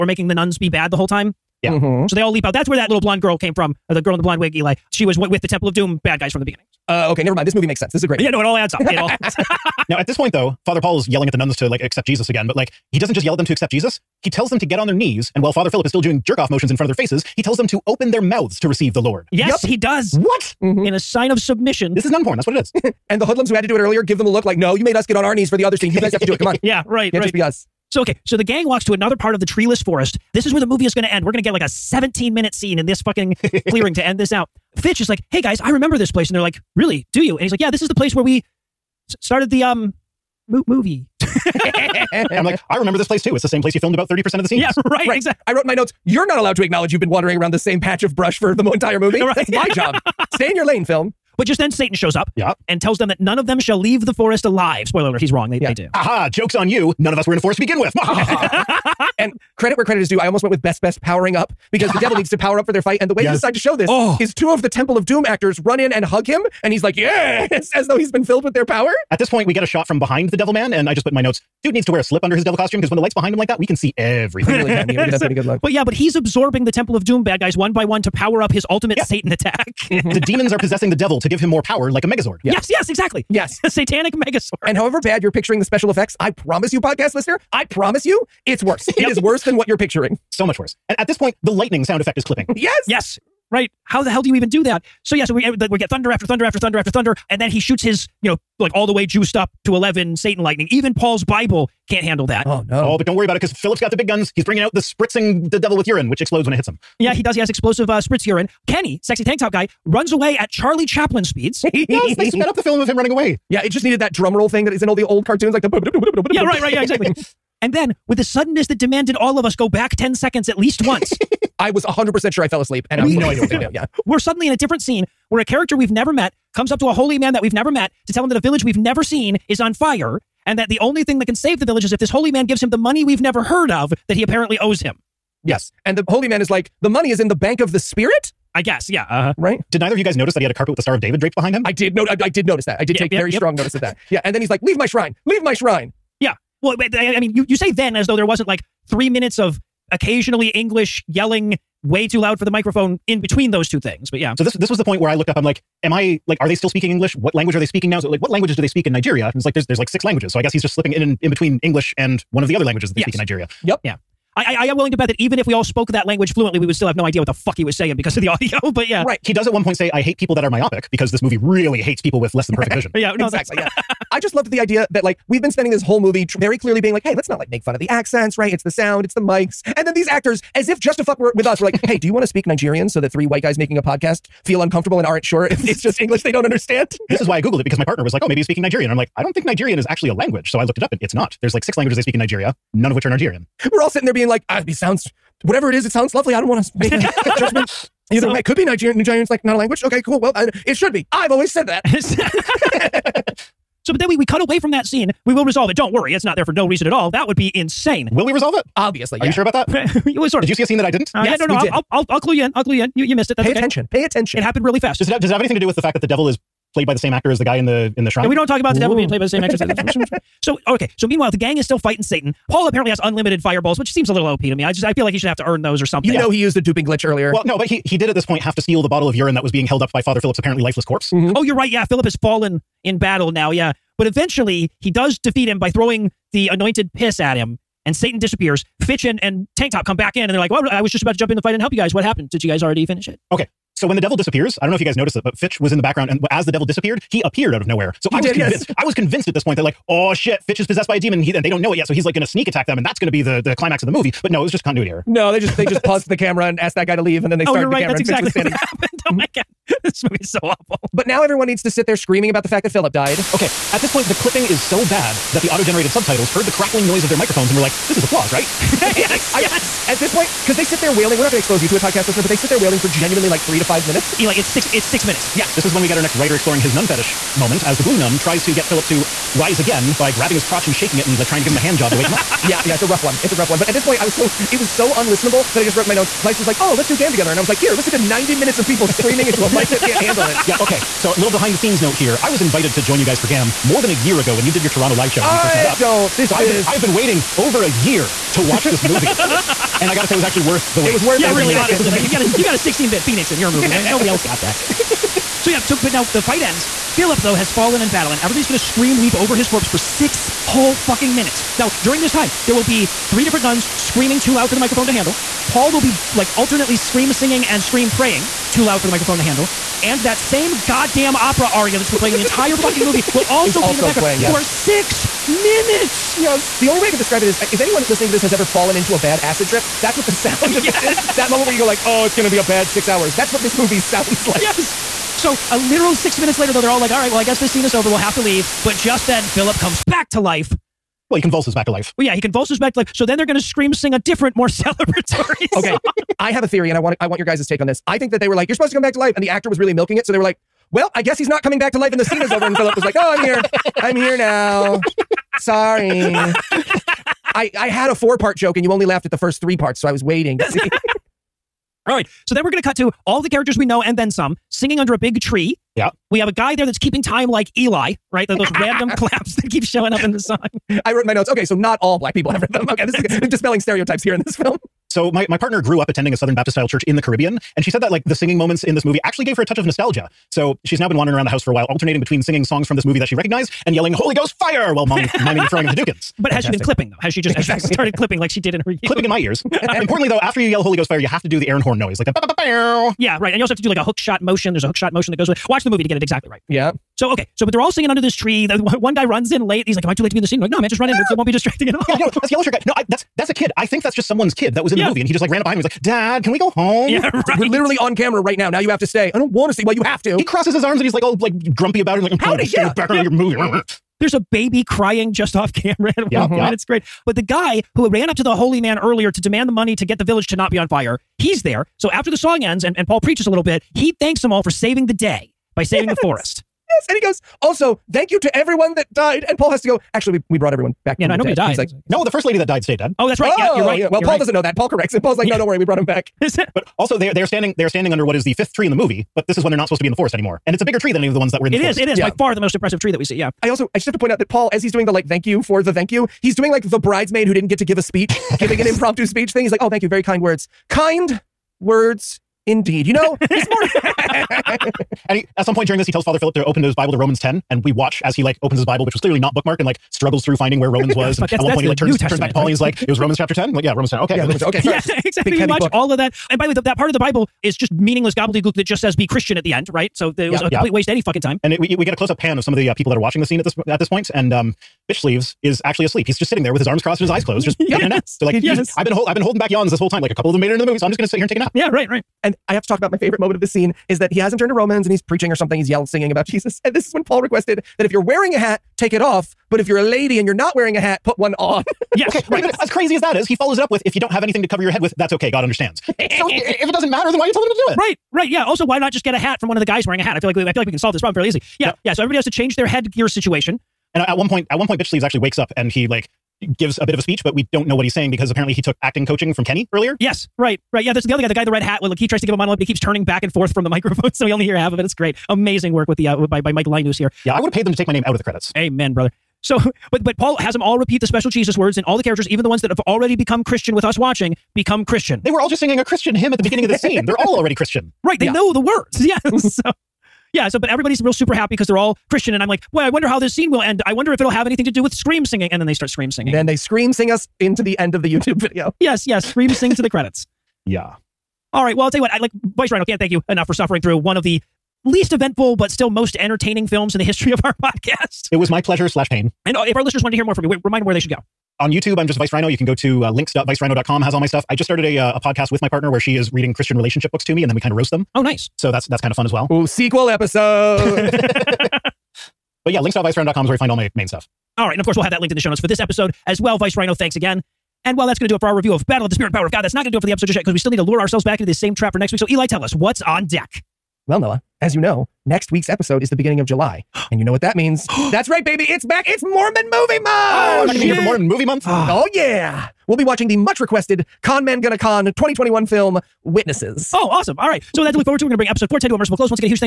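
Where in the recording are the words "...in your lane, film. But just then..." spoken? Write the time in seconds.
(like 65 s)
50 s.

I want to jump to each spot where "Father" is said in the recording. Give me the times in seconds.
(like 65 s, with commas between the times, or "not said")
10 s, 15 s, 230 s, 456 s.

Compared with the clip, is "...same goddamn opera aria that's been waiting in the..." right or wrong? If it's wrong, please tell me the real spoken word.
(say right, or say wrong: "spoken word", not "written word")
wrong: "playing", not "waiting".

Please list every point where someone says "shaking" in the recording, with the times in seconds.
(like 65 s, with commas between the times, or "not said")
280 s.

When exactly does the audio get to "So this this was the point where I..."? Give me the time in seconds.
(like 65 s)
154 s.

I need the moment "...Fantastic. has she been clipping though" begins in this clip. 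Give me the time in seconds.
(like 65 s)
386 s.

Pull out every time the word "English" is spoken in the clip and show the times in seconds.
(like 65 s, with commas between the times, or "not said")
150 s, 156 s, 161 s, 186 s.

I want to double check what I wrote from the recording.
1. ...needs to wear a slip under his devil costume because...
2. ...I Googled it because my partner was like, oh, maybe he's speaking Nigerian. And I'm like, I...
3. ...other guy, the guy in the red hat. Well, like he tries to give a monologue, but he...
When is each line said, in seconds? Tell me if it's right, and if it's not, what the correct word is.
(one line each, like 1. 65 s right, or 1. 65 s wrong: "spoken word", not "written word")
1. 71 s right
2. 187 s right
3. 511 s right.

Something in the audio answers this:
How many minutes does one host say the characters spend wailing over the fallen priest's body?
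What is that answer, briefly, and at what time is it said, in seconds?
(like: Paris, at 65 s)
6, at 274 s.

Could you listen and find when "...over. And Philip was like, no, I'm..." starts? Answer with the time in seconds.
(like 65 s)
352 s.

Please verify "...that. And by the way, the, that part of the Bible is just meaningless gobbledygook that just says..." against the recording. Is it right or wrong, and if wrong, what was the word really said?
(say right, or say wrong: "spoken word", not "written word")
right.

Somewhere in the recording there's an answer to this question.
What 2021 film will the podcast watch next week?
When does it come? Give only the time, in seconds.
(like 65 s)
586 s.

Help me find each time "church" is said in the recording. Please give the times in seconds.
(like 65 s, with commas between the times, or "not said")
376 s.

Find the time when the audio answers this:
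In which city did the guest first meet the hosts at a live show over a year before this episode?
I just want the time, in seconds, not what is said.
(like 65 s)
294 s.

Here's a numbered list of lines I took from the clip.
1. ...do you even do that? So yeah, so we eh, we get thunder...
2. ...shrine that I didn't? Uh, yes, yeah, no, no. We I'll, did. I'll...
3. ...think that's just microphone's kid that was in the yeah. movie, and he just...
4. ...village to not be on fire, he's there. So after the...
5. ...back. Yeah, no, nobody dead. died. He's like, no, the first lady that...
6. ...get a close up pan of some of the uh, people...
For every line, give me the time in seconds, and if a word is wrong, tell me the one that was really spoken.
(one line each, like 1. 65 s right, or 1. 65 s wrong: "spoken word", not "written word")
1. 94 s right
2. 210 s wrong: "scene", not "shrine"
3. 403 s wrong: "someone", not "microphone"
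4. 420 s right
5. 430 s right
6. 471 s right.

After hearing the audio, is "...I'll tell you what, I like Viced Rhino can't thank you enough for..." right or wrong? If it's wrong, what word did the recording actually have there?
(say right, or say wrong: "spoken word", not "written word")
right.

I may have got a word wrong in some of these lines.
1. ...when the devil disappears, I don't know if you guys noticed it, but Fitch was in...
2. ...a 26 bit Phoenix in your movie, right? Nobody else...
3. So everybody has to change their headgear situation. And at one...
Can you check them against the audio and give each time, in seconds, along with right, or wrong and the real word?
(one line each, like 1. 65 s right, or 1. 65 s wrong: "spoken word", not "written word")
1. 243 s right
2. 302 s wrong: "16", not "26"
3. 501 s right.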